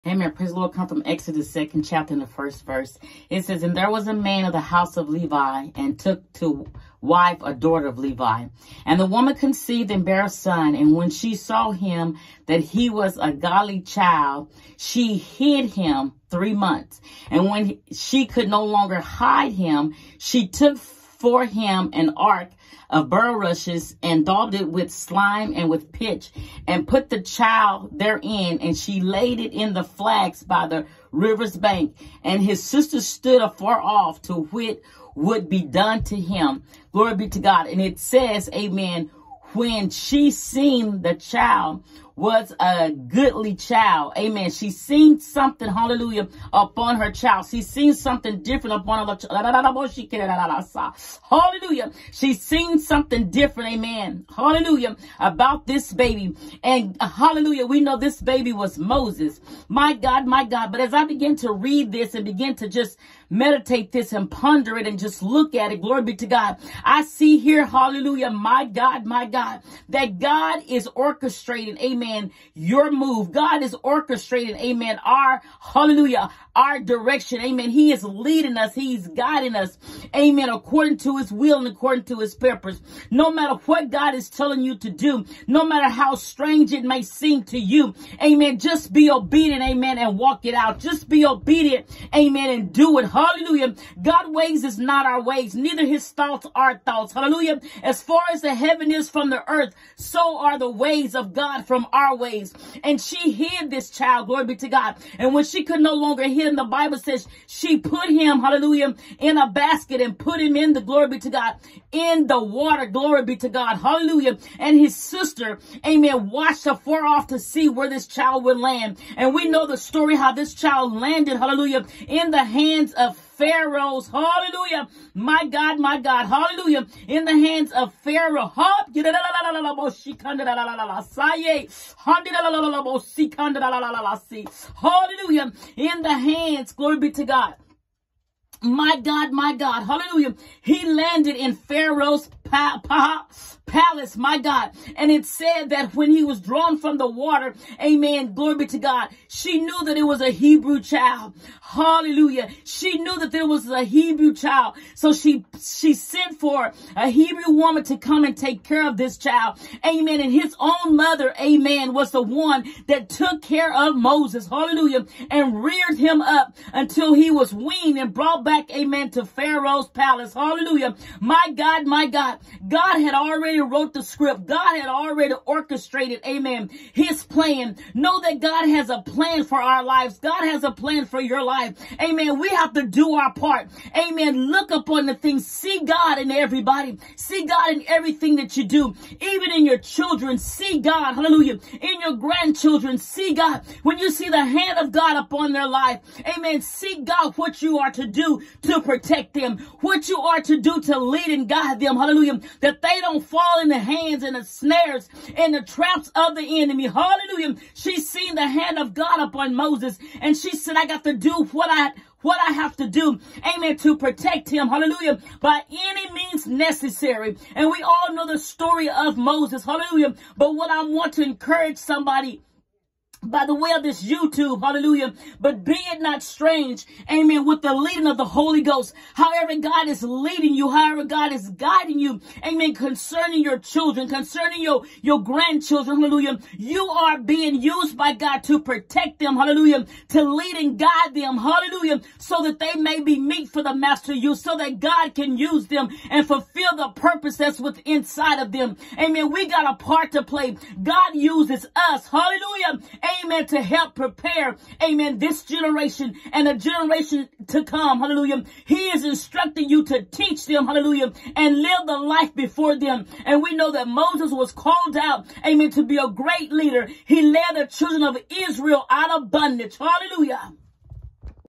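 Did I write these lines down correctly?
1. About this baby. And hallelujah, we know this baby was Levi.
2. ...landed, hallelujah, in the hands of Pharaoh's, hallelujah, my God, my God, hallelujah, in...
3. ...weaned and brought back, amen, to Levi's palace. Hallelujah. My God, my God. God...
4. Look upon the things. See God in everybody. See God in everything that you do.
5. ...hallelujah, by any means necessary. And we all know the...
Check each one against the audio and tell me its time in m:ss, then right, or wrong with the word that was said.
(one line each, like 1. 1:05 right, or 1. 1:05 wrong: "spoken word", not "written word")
1. 0:55 wrong: "Moses", not "Levi"
2. 2:00 right
3. 2:47 wrong: "Pharaoh", not "Levi"
4. 3:04 right
5. 3:34 right.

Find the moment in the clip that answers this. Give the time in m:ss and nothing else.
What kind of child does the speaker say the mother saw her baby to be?
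0:13.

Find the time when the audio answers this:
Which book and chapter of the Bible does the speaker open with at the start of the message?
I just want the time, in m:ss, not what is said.
0:01.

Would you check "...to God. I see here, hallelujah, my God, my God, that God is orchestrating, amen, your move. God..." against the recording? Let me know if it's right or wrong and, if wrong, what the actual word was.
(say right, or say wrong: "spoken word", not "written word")
right.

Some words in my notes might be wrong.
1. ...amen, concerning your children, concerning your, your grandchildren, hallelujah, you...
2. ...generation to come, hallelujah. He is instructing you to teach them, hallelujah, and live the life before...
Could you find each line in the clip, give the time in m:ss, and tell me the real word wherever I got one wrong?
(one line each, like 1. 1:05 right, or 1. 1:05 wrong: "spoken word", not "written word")
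1. 3:52 right
2. 4:16 right.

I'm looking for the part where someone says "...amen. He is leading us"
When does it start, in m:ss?
1:17.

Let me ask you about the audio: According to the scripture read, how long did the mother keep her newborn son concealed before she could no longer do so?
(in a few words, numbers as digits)
3 months.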